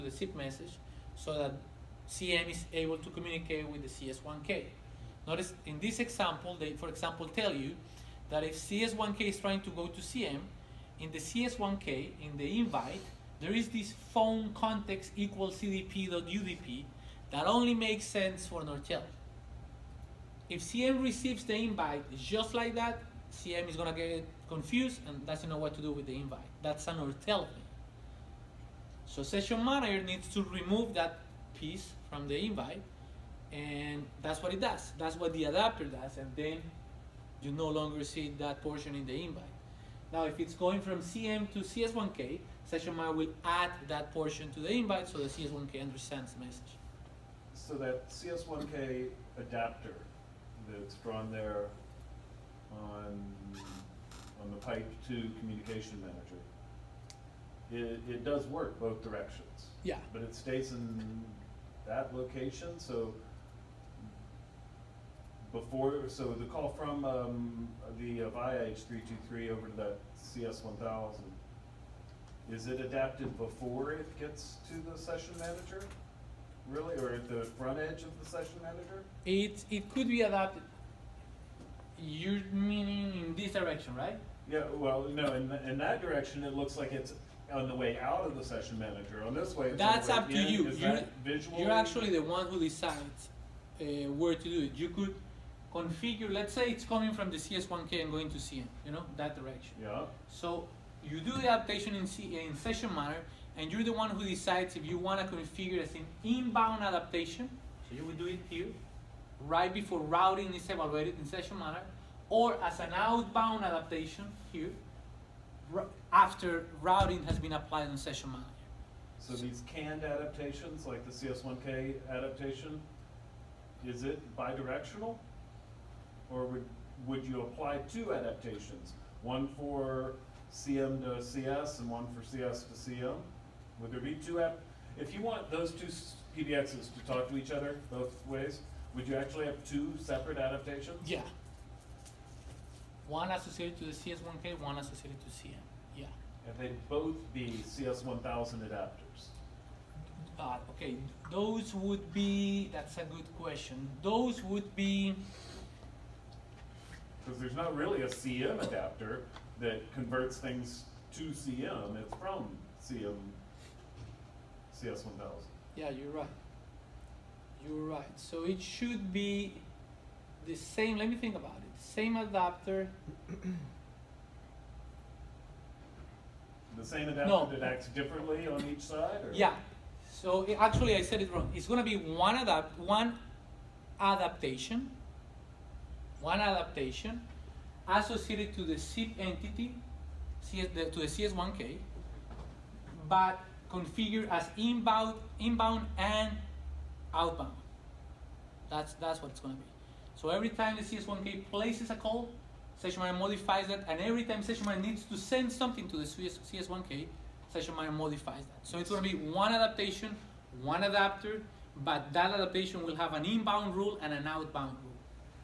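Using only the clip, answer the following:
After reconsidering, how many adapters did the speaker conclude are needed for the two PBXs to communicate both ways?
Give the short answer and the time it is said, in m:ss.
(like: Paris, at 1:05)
1, at 3:30.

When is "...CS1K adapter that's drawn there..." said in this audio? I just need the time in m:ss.
0:48.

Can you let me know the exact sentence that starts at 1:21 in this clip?
You're meaning in this direction, right?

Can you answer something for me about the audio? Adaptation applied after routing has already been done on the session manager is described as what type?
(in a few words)
Outbound adaptation.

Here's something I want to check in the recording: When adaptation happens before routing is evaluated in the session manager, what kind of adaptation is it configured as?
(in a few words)
Inbound adaptation.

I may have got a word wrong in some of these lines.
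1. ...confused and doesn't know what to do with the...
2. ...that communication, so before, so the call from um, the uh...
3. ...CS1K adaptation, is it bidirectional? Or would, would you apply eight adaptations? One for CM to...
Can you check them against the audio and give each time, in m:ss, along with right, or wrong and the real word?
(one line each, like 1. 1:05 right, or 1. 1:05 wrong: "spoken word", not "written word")
1. 0:24 right
2. 1:01 wrong: "location", not "communication"
3. 2:01 wrong: "two", not "eight".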